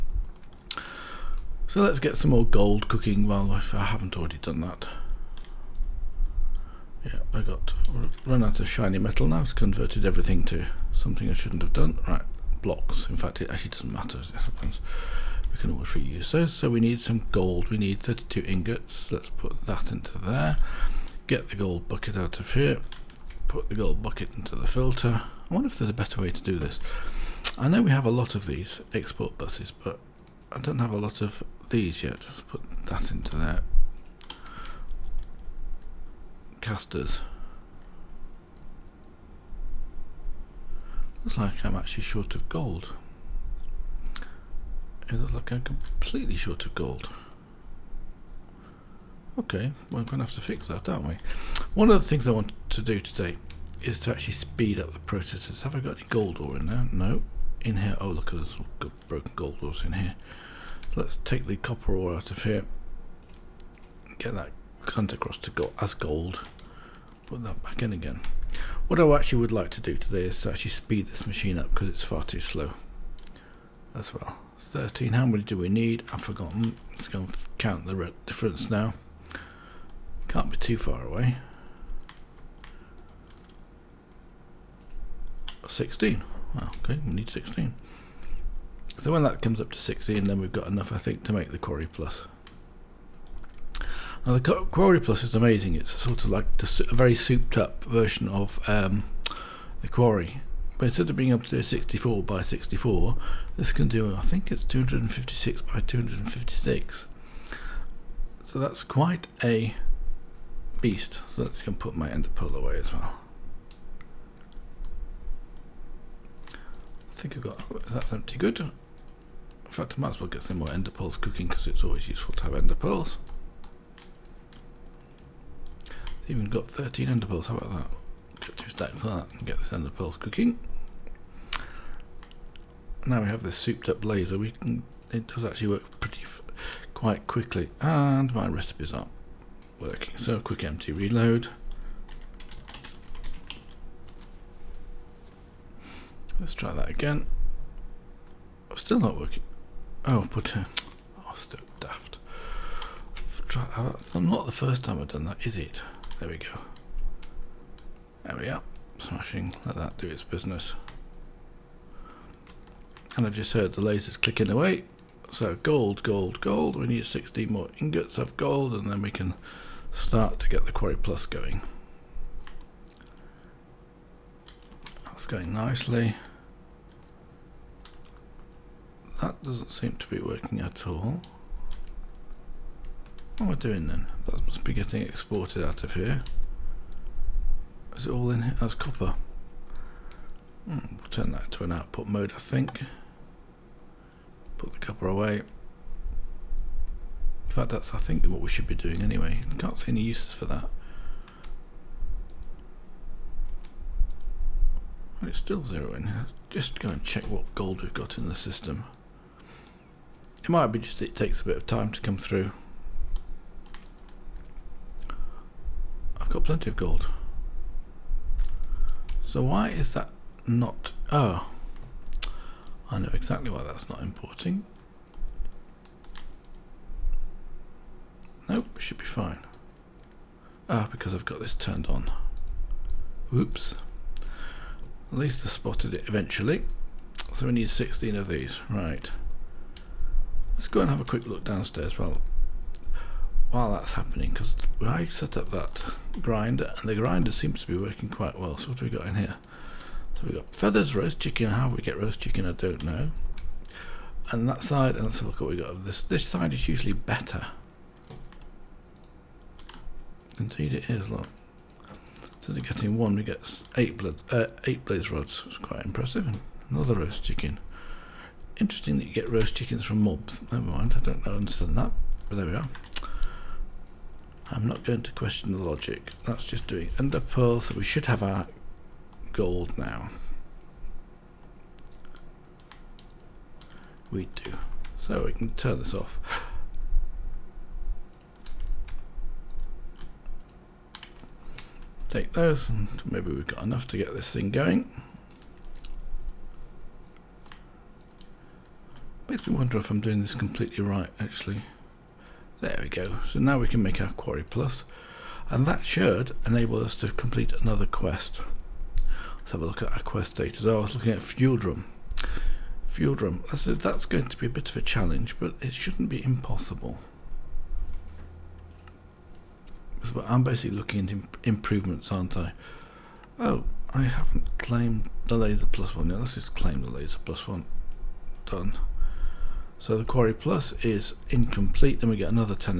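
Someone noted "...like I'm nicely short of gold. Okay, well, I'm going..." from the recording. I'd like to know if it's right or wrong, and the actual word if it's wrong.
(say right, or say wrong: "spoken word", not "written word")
wrong: "completely", not "nicely".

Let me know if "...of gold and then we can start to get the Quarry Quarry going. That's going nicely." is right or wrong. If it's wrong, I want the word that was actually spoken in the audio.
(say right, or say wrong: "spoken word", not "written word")
wrong: "Plus", not "Quarry".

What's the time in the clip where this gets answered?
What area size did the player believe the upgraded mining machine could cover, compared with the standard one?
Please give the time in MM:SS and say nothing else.
01:44.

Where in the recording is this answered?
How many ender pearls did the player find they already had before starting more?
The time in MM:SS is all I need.
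02:06.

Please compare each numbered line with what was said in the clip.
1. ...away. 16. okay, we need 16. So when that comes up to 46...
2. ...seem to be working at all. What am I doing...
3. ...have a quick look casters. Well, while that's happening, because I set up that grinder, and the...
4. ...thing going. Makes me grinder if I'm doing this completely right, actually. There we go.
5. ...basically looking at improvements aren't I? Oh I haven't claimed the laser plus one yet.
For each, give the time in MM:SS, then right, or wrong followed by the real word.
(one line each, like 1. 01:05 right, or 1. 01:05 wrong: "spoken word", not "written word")
1. 01:21 wrong: "16", not "46"
2. 02:59 right
3. 04:00 wrong: "downstairs", not "casters"
4. 04:54 wrong: "wonder", not "grinder"
5. 05:20 right.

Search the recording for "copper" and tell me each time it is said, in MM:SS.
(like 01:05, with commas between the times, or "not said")
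01:01, 03:08, 03:14.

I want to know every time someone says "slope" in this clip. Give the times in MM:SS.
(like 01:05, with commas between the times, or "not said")
not said.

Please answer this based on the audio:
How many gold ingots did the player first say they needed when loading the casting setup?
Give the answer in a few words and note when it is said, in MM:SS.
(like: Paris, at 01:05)
32, at 00:18.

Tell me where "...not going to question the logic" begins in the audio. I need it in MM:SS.
04:34.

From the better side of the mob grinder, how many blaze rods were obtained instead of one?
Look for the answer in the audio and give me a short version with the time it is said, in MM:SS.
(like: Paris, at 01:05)
8, at 04:24.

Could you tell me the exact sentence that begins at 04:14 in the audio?
And that side, and let's look what we got.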